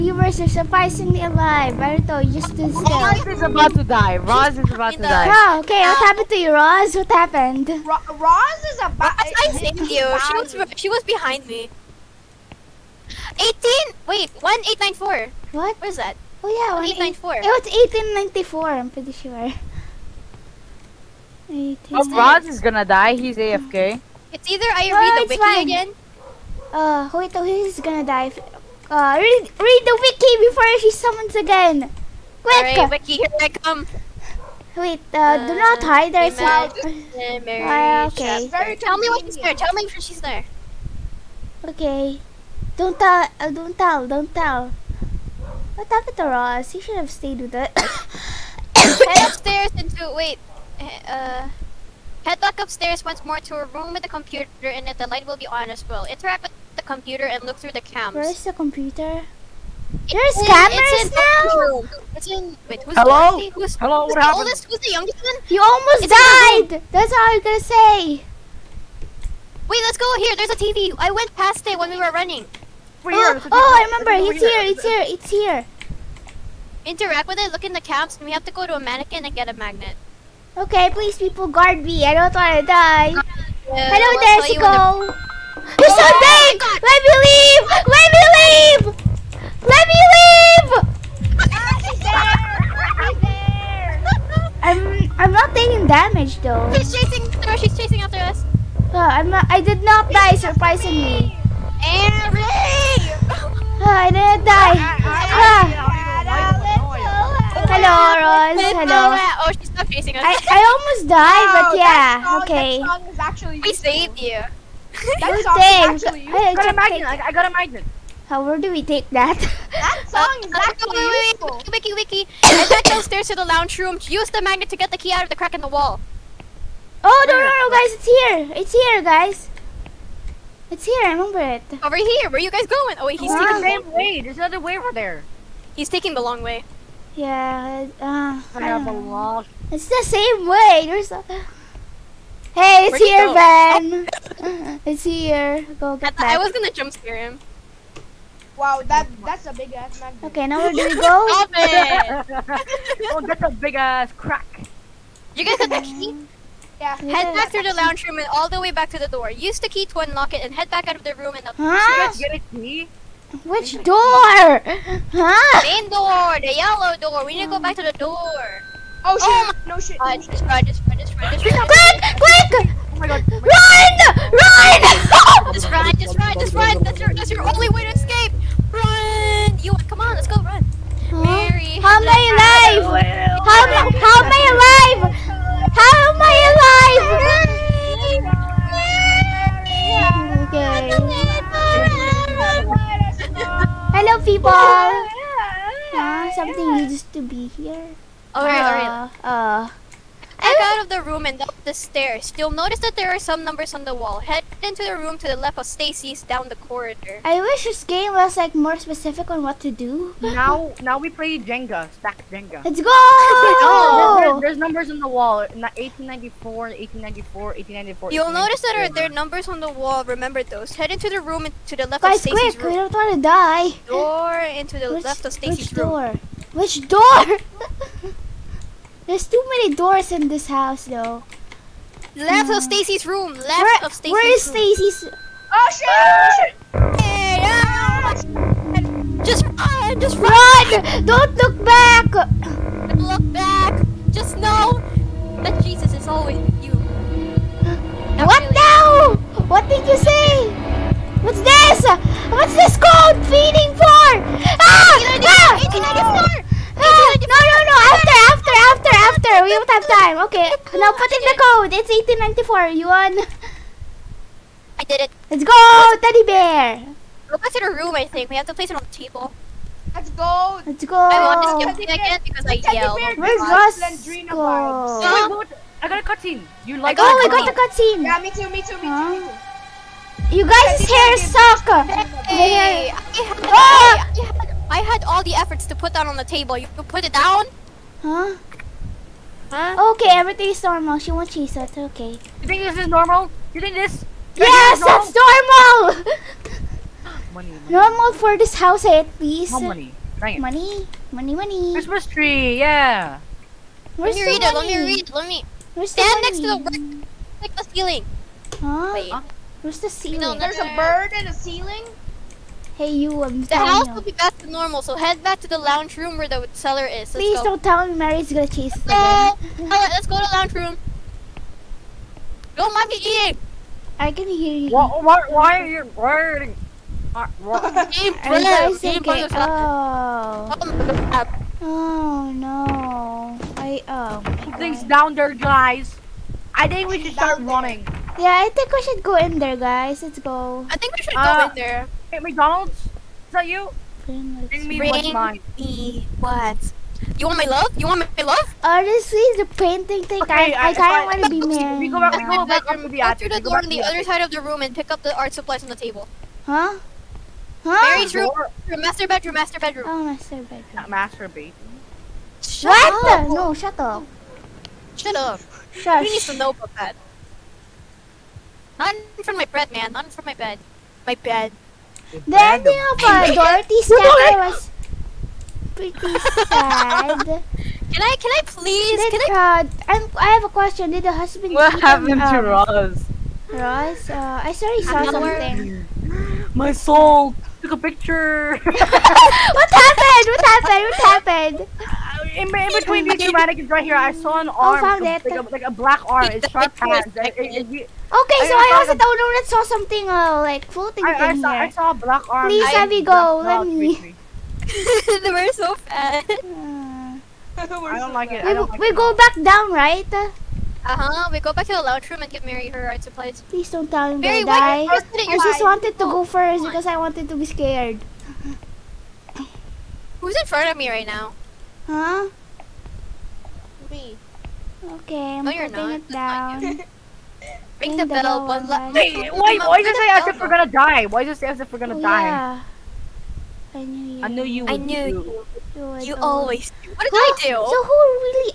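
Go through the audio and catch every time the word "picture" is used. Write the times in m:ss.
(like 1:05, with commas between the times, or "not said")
6:27.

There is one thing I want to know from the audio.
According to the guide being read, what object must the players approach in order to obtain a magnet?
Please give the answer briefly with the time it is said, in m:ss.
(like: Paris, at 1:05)
mannequin, at 1:18.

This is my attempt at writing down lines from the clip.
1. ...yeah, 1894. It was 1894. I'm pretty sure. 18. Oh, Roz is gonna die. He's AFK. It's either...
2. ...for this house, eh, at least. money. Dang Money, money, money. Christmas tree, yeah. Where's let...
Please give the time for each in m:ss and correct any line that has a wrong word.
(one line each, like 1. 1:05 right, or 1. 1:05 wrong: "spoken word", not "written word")
1. 0:16 right
2. 4:58 right.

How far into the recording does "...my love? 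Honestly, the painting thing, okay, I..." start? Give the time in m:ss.
5:48.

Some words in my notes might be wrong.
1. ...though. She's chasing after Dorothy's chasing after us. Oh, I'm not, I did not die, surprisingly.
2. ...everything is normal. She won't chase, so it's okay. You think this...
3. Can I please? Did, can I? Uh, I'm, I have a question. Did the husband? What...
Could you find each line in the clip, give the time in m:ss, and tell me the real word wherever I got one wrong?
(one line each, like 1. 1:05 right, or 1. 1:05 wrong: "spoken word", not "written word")
1. 1:36 wrong: "She", not "Dorothy"
2. 4:50 wrong: "cheese", not "chase"
3. 6:18 right.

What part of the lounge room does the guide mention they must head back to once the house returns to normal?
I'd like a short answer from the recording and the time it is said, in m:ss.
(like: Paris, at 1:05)
cellar, at 5:16.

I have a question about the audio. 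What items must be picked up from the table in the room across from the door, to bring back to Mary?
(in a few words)
art supplies.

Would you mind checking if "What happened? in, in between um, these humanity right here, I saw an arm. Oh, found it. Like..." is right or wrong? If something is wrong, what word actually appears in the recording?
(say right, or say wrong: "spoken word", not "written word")
right.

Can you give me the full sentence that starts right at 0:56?
Interact with computer and look through the cams.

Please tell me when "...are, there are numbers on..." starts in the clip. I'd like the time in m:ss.
3:38.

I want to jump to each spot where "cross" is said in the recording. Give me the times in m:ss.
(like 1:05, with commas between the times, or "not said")
not said.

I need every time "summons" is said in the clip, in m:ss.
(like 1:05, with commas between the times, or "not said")
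0:30.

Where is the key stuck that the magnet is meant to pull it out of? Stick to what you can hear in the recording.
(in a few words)
crack in the wall.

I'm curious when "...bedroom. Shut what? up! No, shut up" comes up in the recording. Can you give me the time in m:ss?
6:01.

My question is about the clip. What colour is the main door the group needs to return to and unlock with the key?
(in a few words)
yellow.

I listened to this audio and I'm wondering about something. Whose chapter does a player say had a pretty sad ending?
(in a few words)
Dorothy.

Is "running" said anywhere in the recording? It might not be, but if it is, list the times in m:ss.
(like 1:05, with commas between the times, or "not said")
1:12, 5:37.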